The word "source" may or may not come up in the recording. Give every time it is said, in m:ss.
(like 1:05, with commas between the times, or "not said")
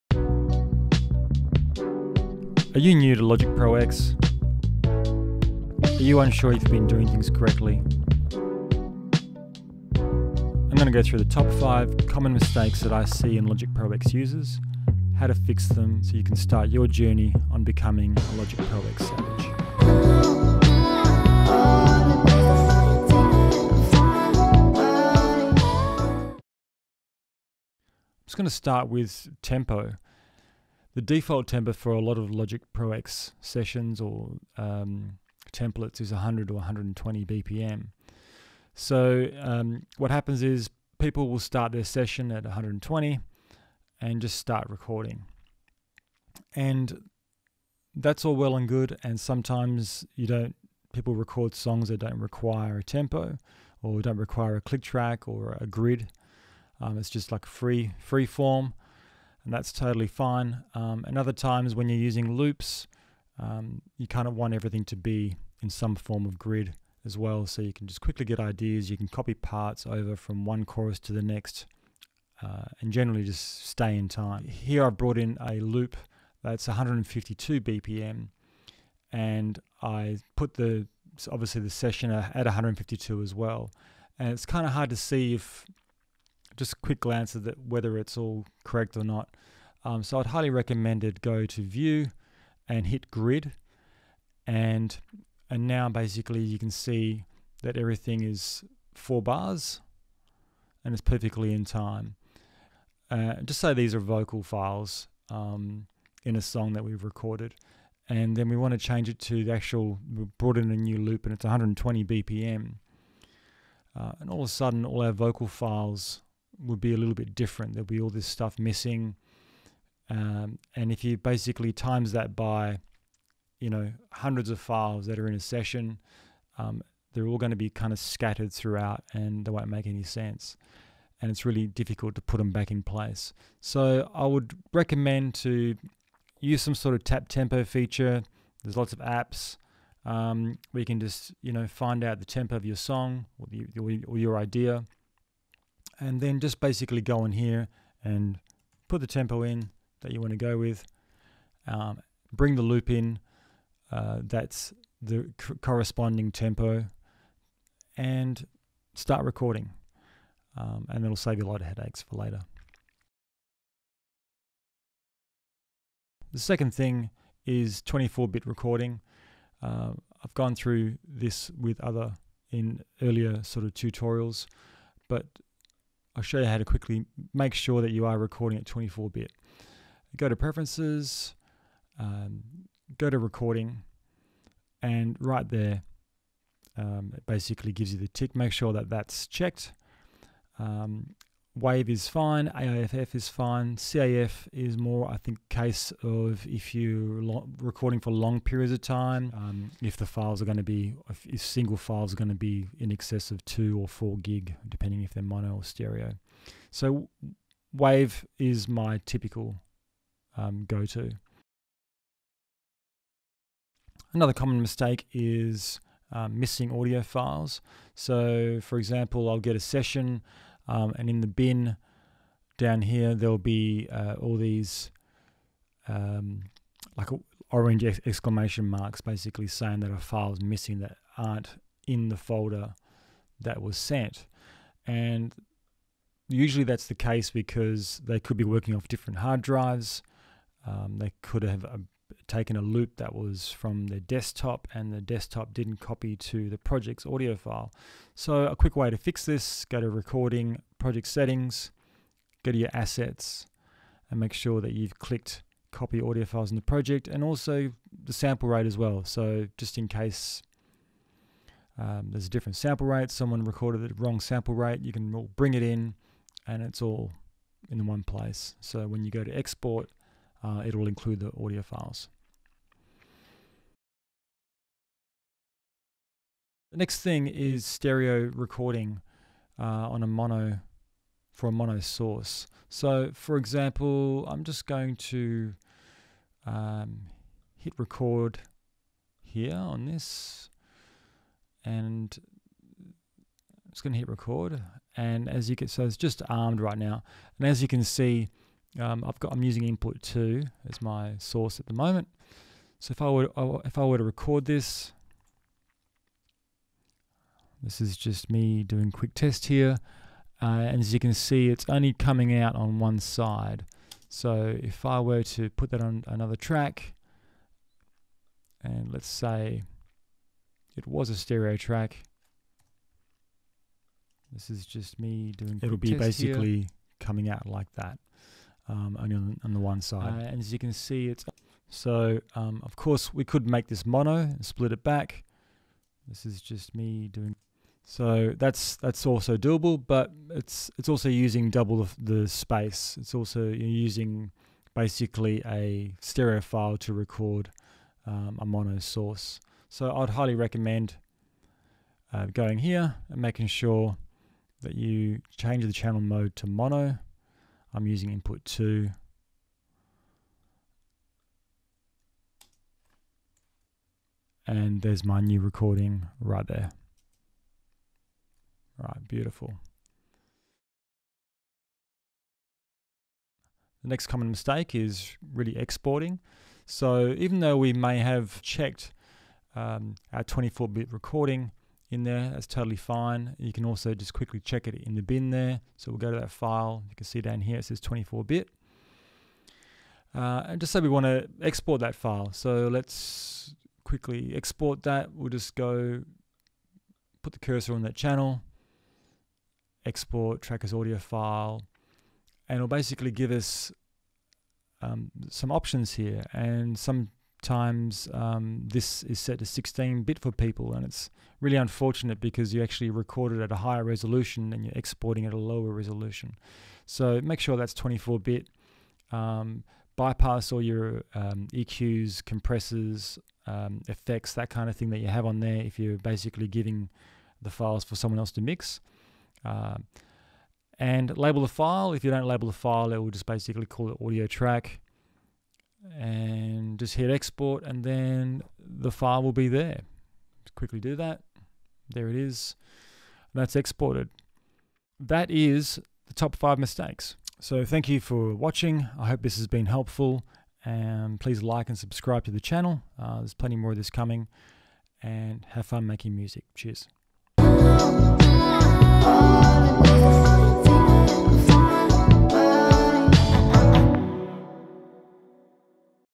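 4:41, 5:01, 5:48.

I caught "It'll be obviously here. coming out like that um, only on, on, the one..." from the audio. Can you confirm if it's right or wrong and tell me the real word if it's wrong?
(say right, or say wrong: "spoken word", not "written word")
wrong: "basically", not "obviously".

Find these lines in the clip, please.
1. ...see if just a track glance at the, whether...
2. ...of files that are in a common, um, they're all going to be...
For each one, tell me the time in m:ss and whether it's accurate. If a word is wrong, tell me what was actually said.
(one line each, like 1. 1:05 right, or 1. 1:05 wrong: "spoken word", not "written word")
1. 1:24 wrong: "quick", not "track"
2. 2:04 wrong: "session", not "common".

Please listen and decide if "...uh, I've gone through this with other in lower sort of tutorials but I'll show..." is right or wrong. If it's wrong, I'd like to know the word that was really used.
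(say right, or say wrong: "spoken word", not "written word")
wrong: "earlier", not "lower".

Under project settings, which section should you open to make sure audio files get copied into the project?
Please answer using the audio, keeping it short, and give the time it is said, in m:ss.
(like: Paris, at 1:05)
assets, at 4:12.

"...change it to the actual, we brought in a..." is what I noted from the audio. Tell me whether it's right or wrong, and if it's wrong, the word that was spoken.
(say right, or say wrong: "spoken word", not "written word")
right.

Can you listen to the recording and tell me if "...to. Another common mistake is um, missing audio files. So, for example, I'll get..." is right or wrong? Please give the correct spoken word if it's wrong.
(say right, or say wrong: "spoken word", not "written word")
right.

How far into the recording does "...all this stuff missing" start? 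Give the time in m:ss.
1:57.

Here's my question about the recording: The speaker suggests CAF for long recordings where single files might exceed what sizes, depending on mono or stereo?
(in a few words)
2 or 4 gig.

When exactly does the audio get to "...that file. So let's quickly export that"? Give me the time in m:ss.
6:31.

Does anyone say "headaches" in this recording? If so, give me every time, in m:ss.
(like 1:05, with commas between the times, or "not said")
2:41.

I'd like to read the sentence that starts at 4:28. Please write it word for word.
So when you go to export, uh, it will include the audio files.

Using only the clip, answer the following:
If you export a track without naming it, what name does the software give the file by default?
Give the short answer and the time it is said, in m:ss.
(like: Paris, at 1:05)
audio track, at 7:14.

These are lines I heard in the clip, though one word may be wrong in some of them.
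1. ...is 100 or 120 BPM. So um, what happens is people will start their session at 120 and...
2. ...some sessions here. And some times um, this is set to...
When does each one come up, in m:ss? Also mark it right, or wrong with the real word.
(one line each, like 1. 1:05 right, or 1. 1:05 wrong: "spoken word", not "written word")
1. 0:36 right
2. 6:45 wrong: "options", not "sessions".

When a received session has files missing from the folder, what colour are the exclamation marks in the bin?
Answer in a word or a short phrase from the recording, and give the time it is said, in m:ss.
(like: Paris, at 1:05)
orange, at 3:47.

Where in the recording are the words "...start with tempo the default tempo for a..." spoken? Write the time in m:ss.
0:28.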